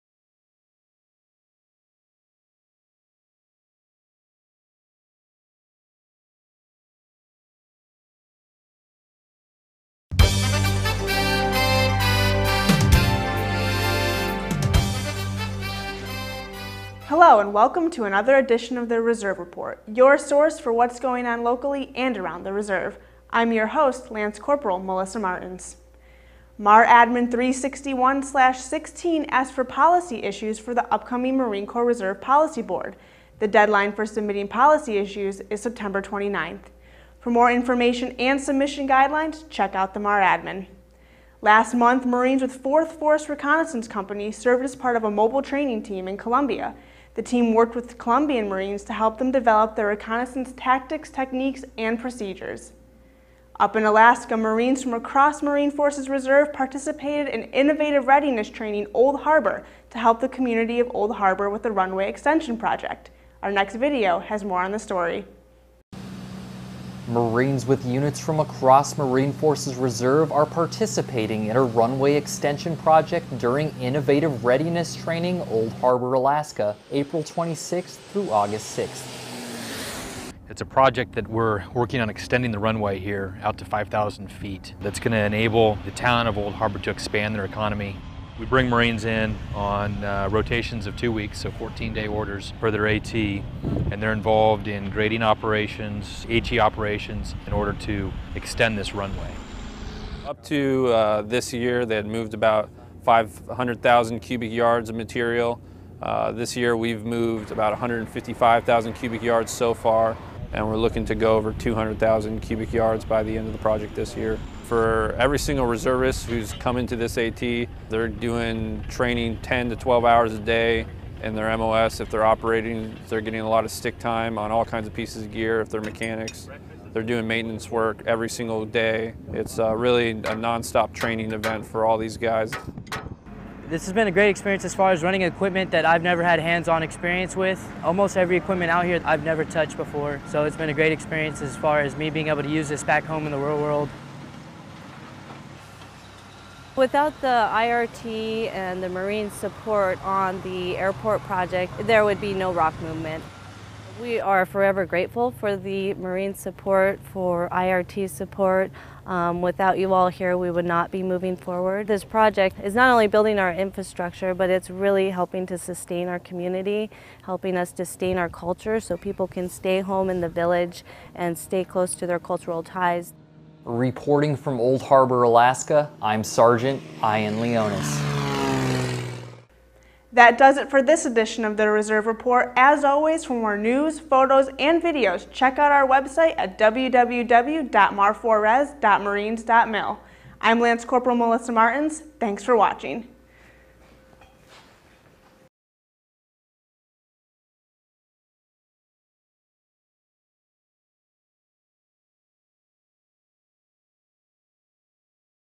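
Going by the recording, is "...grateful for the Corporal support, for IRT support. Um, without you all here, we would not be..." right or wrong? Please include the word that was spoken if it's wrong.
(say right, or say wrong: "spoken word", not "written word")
wrong: "Marine", not "Corporal".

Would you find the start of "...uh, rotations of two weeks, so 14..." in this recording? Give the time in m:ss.
1:30.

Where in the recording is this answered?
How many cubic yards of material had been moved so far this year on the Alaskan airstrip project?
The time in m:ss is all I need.
1:47.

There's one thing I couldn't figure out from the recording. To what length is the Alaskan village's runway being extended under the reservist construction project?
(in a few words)
5,000 feet.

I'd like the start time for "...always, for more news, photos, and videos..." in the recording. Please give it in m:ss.
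3:02.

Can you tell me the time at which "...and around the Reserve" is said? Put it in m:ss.
0:21.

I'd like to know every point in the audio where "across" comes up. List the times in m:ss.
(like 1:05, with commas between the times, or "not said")
0:54, 1:08.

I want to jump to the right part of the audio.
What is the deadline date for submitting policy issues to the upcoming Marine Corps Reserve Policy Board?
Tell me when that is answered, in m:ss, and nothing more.
0:35.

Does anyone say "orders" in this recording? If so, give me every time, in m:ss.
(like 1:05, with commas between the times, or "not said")
1:32, 1:37.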